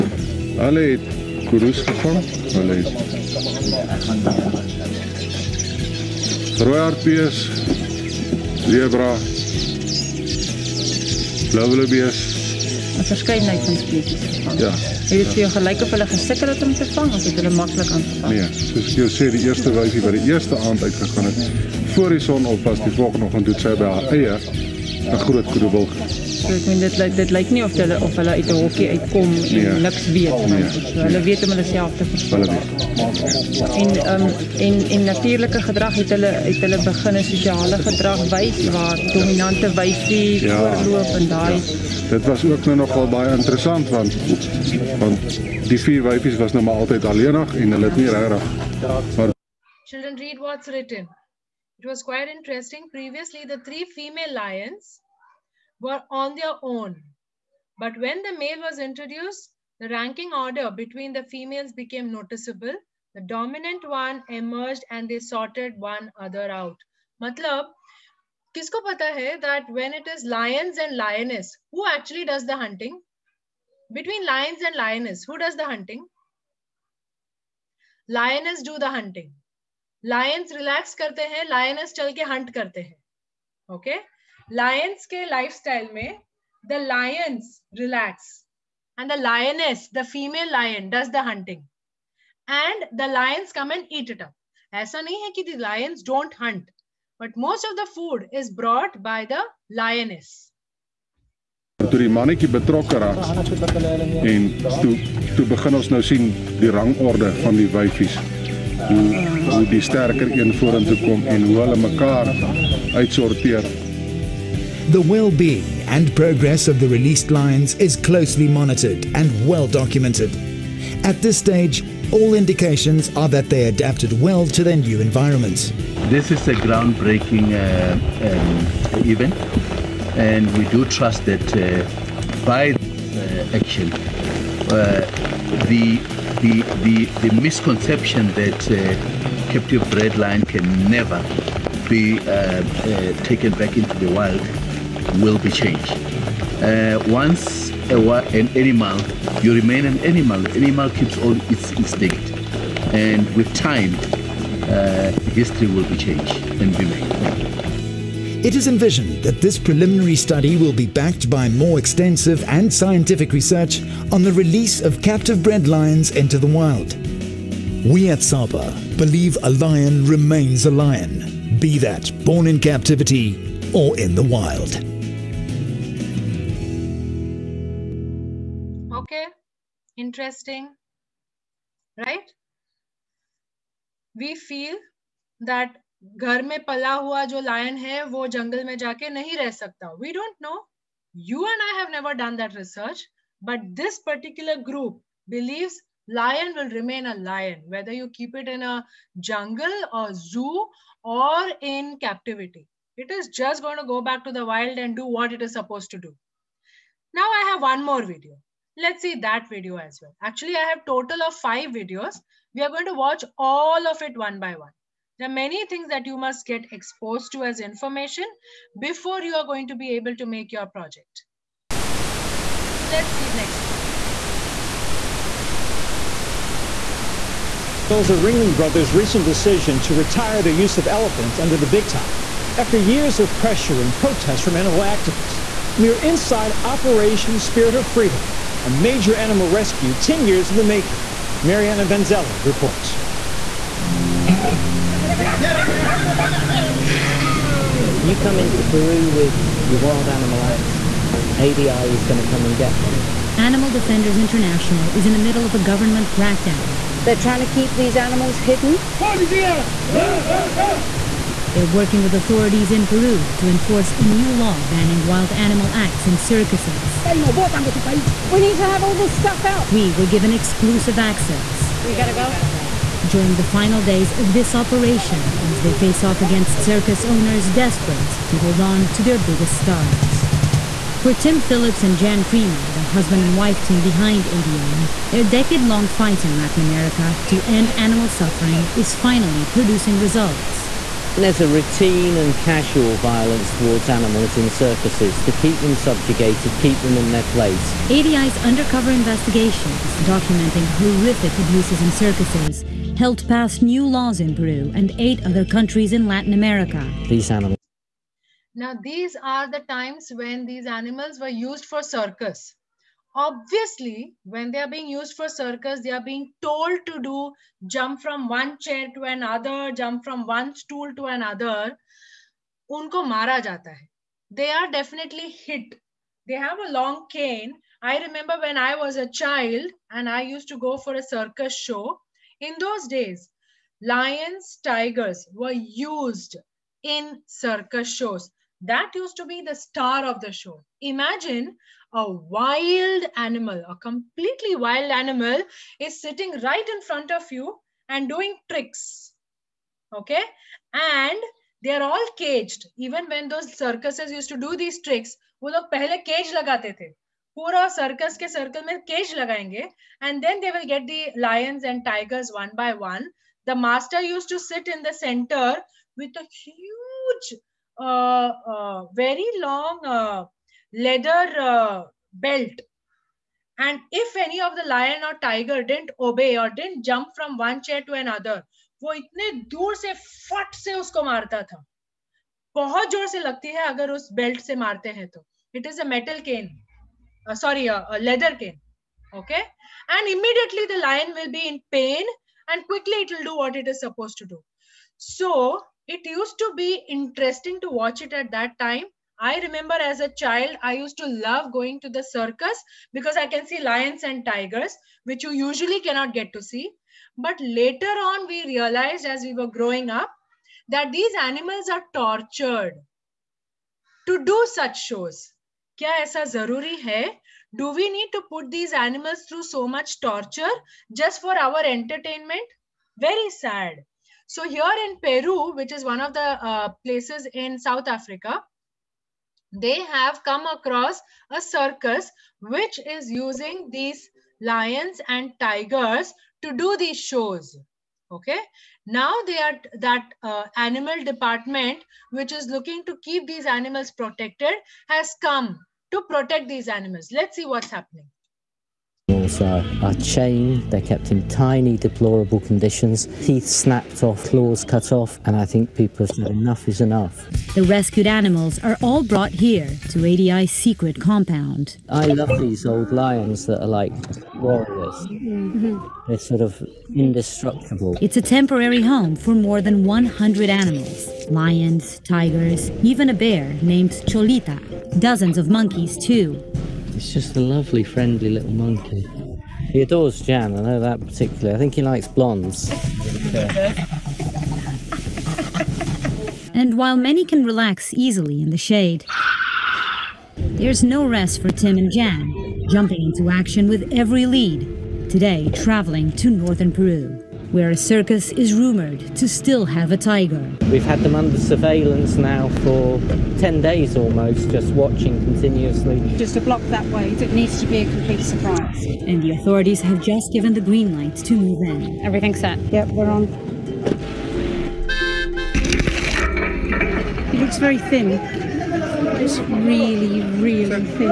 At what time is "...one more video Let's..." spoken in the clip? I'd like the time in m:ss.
3:27.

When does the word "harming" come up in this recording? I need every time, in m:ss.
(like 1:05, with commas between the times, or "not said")
not said.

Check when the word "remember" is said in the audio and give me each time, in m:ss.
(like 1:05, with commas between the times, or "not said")
5:28, 6:39.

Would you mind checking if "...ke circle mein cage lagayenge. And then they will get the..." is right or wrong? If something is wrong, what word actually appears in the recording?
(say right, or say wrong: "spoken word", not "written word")
right.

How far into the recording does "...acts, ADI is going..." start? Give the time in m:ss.
4:10.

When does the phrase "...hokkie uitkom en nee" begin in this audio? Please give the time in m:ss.
0:28.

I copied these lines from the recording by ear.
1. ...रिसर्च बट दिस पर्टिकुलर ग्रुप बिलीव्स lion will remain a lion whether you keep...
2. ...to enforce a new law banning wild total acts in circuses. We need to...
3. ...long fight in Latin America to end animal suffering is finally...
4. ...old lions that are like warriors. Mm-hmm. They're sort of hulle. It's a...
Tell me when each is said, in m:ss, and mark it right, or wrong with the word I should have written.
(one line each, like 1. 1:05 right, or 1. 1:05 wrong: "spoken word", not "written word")
1. 3:12 right
2. 4:23 wrong: "animal", not "total"
3. 4:45 right
4. 7:42 wrong: "indestructible", not "hulle".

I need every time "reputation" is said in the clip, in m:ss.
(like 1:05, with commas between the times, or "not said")
not said.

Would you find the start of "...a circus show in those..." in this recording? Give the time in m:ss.
5:30.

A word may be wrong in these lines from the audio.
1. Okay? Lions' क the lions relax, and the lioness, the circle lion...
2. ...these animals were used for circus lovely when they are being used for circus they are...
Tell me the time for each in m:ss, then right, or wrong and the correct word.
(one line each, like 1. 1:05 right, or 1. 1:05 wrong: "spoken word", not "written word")
1. 1:23 wrong: "female", not "circle"
2. 5:10 wrong: "obviously", not "lovely".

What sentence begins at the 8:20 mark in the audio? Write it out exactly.
We've had them under surveillance now for 10 days almost, just watching continuously.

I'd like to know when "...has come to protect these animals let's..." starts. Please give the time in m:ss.
7:24.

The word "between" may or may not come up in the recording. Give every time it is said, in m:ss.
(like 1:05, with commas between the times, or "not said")
1:00, 1:13.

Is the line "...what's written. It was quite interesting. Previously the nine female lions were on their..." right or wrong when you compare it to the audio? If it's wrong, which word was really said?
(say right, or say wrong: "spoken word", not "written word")
wrong: "three", not "nine".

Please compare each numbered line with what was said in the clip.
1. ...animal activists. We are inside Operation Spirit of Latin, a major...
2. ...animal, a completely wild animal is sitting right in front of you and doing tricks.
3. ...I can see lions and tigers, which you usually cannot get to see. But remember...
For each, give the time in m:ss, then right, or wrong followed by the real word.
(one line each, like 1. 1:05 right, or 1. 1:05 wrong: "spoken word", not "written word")
1. 3:54 wrong: "Freedom", not "Latin"
2. 5:43 right
3. 6:43 wrong: "later", not "remember".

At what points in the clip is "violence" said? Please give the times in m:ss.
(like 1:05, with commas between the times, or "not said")
4:52.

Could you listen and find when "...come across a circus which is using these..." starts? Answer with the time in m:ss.
7:10.